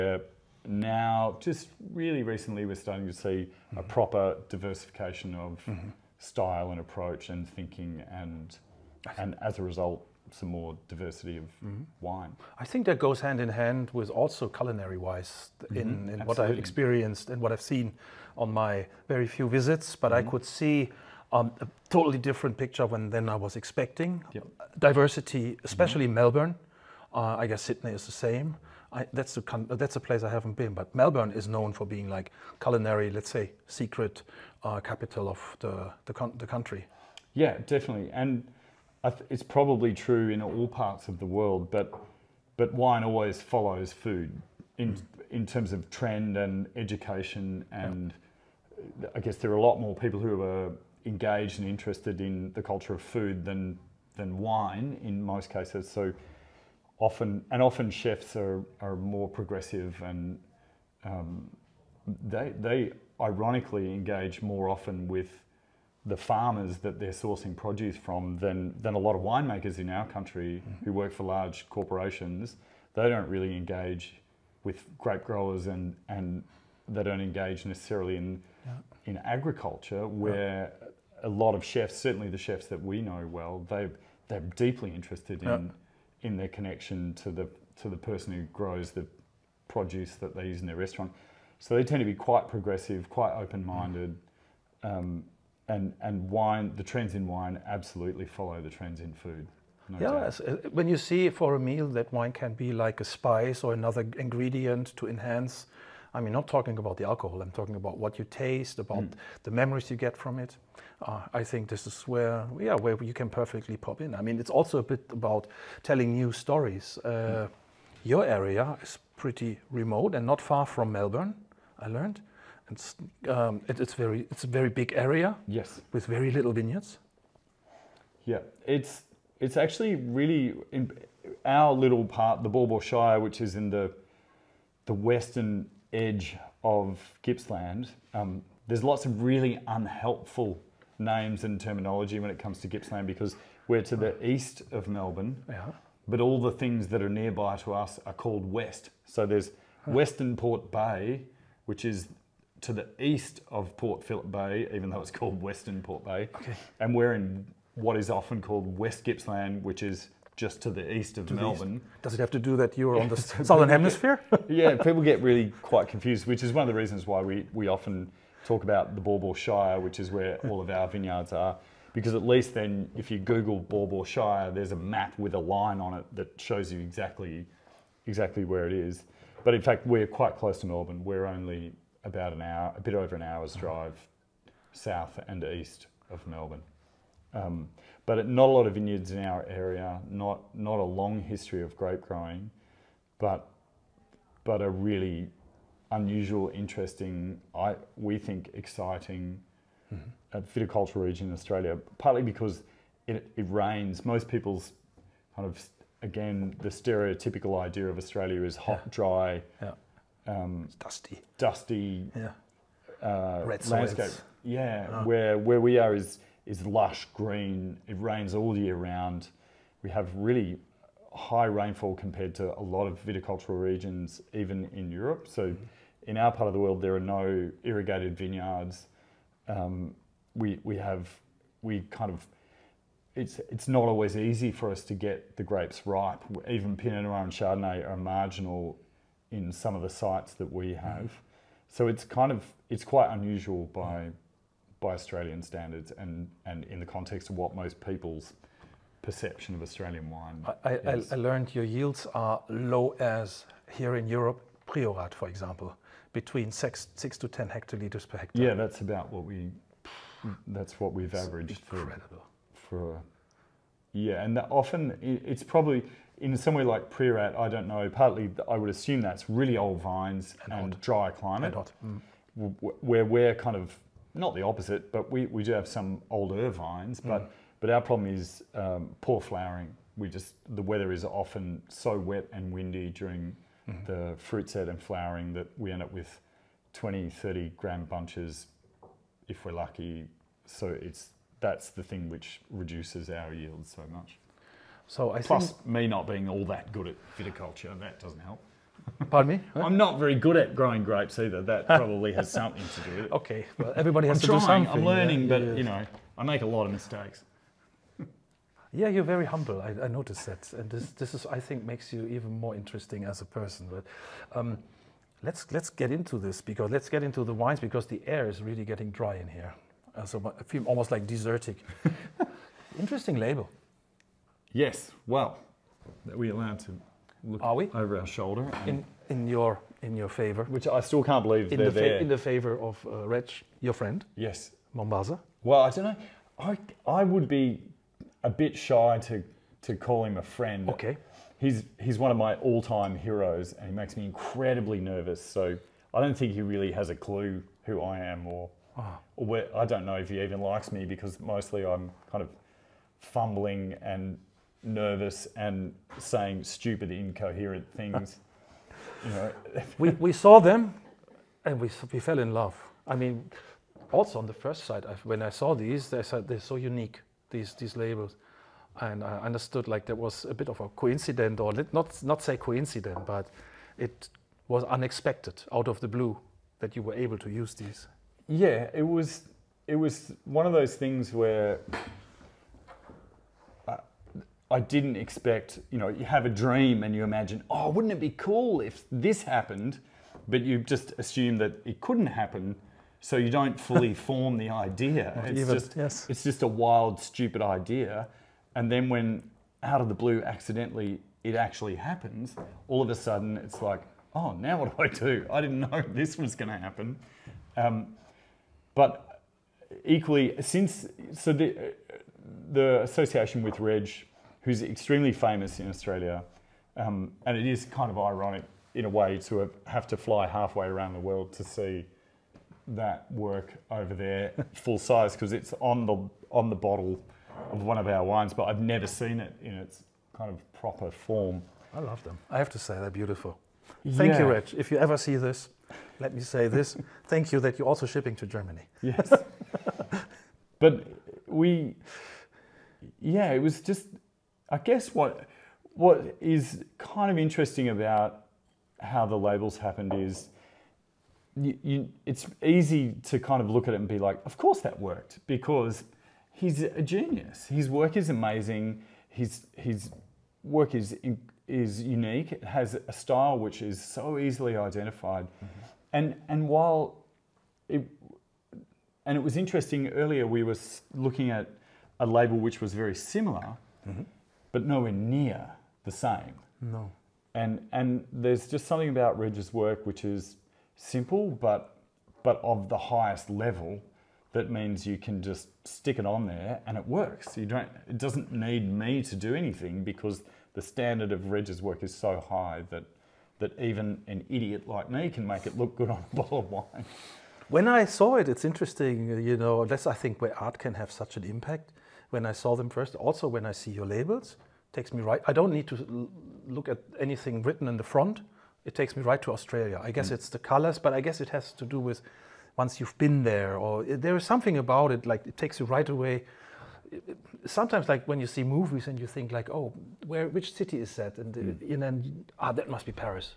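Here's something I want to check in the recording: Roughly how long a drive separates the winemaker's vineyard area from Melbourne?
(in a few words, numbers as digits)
a bit over an hour.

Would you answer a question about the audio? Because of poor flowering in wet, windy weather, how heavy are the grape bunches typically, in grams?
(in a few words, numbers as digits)
20 to 30 grams.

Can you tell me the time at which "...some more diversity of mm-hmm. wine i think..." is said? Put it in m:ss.
0:10.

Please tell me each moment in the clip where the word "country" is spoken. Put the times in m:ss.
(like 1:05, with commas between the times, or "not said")
0:36, 1:10.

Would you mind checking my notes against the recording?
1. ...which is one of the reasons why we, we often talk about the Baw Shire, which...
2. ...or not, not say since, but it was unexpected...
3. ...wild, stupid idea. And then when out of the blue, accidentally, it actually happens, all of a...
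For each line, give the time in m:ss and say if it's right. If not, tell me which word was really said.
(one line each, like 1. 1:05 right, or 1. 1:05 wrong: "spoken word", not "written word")
1. 2:46 right
2. 6:11 wrong: "coincidence", not "since"
3. 6:36 right.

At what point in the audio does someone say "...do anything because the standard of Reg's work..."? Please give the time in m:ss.
8:09.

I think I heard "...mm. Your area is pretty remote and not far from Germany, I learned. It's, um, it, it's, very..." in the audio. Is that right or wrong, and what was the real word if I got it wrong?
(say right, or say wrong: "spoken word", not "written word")
wrong: "Melbourne", not "Germany".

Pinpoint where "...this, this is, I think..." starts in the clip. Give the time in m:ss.
5:10.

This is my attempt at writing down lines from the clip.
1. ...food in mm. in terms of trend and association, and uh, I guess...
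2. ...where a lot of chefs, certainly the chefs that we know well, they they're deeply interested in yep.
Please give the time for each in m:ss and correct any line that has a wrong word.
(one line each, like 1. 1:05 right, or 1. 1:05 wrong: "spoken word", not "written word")
1. 0:43 wrong: "education", not "association"
2. 1:20 right.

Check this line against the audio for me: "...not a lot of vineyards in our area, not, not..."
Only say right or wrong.
right.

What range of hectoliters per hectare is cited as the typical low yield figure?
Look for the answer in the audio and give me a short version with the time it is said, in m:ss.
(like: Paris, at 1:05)
6 to 10, at 4:16.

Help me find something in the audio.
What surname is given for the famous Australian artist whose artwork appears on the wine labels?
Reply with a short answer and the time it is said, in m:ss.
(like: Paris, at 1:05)
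Mombassa, at 5:34.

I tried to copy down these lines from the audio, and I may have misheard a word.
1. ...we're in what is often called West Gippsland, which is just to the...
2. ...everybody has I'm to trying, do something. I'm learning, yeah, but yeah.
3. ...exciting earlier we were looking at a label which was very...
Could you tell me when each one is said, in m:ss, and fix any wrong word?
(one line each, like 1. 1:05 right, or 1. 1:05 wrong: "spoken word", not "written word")
1. 2:36 right
2. 5:03 right
3. 7:49 wrong: "interesting", not "exciting".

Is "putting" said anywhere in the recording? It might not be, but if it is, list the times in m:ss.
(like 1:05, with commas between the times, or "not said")
not said.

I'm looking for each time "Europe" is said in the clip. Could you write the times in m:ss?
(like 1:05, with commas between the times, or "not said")
3:44, 4:14.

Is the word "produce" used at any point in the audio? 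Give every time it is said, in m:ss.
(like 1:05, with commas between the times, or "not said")
1:07, 1:29.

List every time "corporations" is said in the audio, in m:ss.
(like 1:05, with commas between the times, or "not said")
1:11.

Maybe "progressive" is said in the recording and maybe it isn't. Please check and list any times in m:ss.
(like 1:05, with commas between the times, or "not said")
0:59, 1:32.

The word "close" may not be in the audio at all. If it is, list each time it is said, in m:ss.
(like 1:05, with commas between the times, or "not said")
3:00.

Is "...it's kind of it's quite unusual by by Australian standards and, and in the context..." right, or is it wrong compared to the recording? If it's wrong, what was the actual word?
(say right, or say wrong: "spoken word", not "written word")
right.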